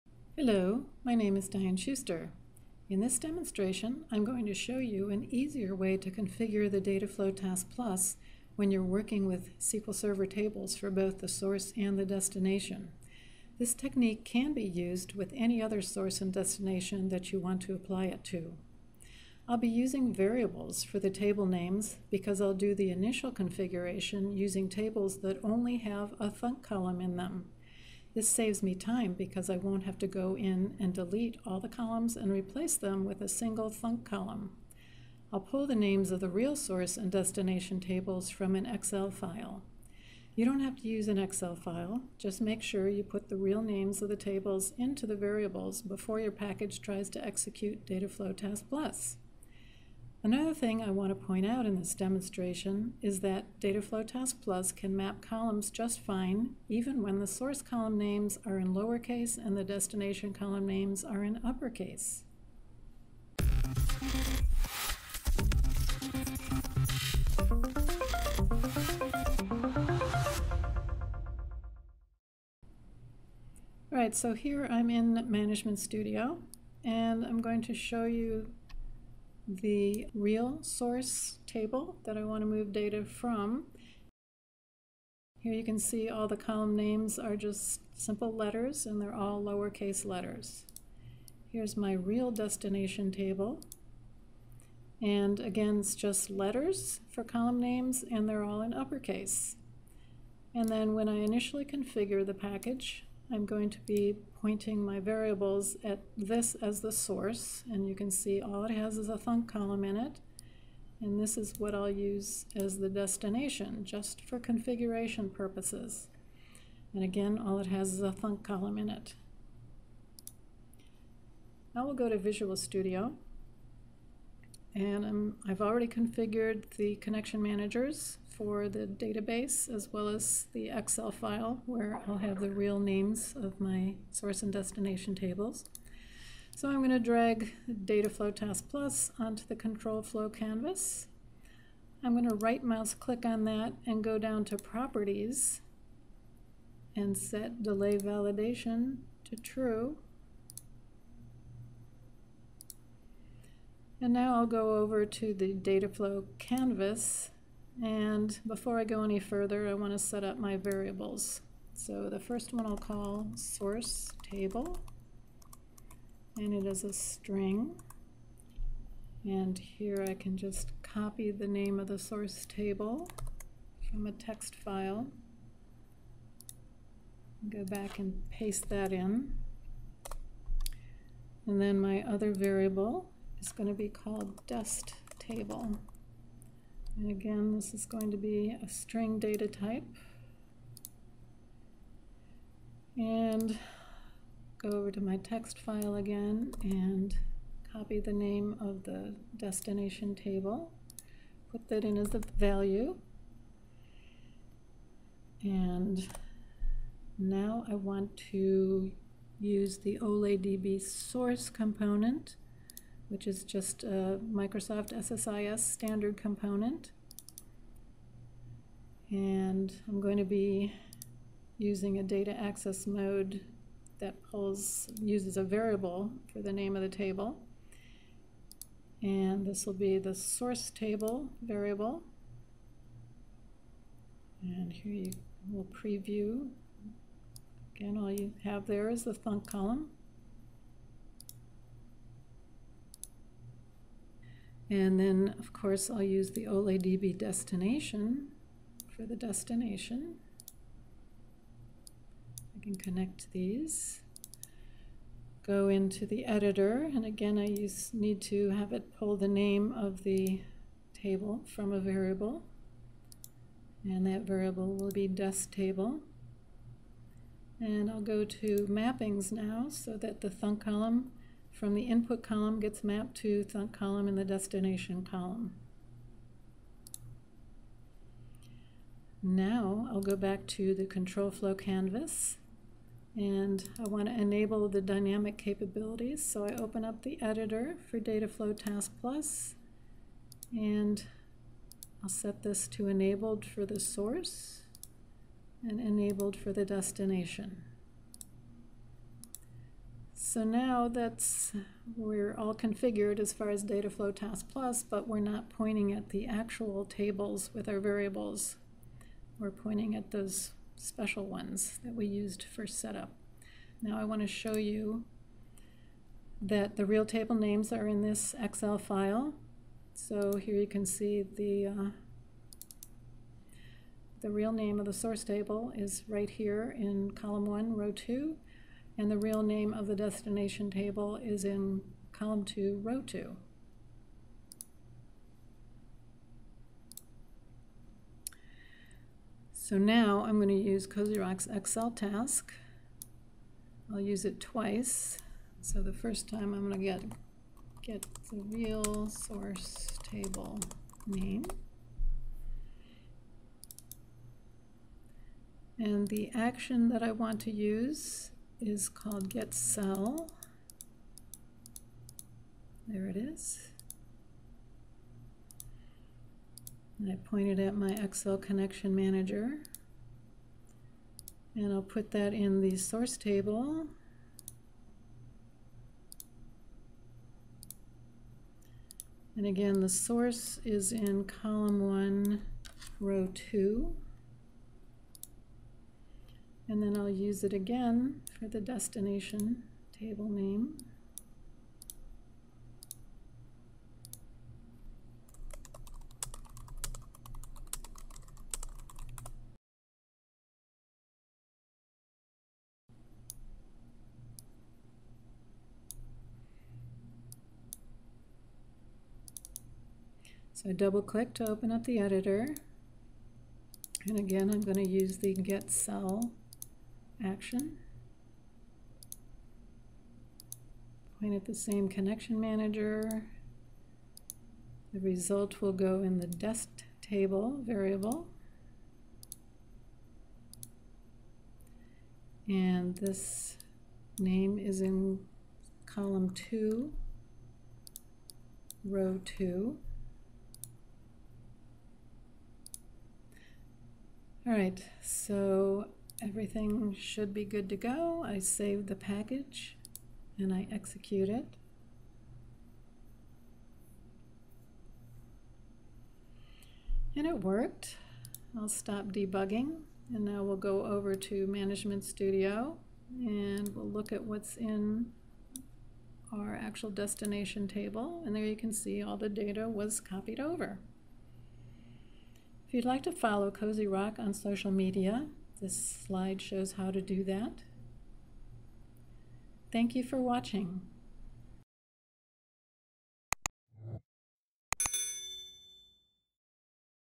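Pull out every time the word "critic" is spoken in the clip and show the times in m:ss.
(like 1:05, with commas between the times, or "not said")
not said.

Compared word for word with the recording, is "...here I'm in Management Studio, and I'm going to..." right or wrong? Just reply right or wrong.
right.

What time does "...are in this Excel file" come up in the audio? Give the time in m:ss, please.
5:17.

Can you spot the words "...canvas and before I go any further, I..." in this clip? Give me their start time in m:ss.
2:36.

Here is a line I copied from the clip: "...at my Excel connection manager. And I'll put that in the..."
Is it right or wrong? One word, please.
right.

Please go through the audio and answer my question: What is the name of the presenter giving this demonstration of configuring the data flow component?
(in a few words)
Diane Schuster.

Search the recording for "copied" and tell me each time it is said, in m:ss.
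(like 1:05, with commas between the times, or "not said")
7:49.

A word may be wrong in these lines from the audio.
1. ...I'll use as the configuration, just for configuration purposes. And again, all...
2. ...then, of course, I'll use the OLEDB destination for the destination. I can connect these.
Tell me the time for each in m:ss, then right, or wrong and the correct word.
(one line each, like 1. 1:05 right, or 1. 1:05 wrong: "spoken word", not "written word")
1. 1:51 wrong: "destination", not "configuration"
2. 4:05 right.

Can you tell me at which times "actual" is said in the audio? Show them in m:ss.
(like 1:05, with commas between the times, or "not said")
5:06, 7:46.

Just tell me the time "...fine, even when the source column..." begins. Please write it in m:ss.
0:55.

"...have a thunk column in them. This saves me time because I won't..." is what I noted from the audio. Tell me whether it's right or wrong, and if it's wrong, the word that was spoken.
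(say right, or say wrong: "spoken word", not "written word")
right.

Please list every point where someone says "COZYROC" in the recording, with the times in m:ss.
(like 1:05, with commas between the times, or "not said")
5:40, 7:53.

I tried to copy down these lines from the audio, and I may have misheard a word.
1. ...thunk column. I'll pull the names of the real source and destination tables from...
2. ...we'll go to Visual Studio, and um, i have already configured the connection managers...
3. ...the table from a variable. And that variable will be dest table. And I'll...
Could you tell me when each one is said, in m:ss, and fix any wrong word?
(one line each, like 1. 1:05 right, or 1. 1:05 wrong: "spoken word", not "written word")
1. 0:33 right
2. 2:01 right
3. 4:20 right.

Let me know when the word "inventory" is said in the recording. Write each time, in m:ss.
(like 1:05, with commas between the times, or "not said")
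not said.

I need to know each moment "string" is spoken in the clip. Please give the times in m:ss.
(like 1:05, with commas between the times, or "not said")
2:46, 3:08.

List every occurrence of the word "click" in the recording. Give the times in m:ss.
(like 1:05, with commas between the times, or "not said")
2:22, 6:51.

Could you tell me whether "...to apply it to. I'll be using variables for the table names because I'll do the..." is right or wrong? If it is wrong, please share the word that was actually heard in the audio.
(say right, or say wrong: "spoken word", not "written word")
right.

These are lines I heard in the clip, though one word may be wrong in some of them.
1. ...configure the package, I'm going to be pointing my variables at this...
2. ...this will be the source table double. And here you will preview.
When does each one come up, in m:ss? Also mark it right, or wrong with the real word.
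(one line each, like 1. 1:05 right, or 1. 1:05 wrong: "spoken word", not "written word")
1. 1:41 right
2. 3:49 wrong: "variable", not "double".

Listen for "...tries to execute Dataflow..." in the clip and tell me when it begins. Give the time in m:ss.
0:46.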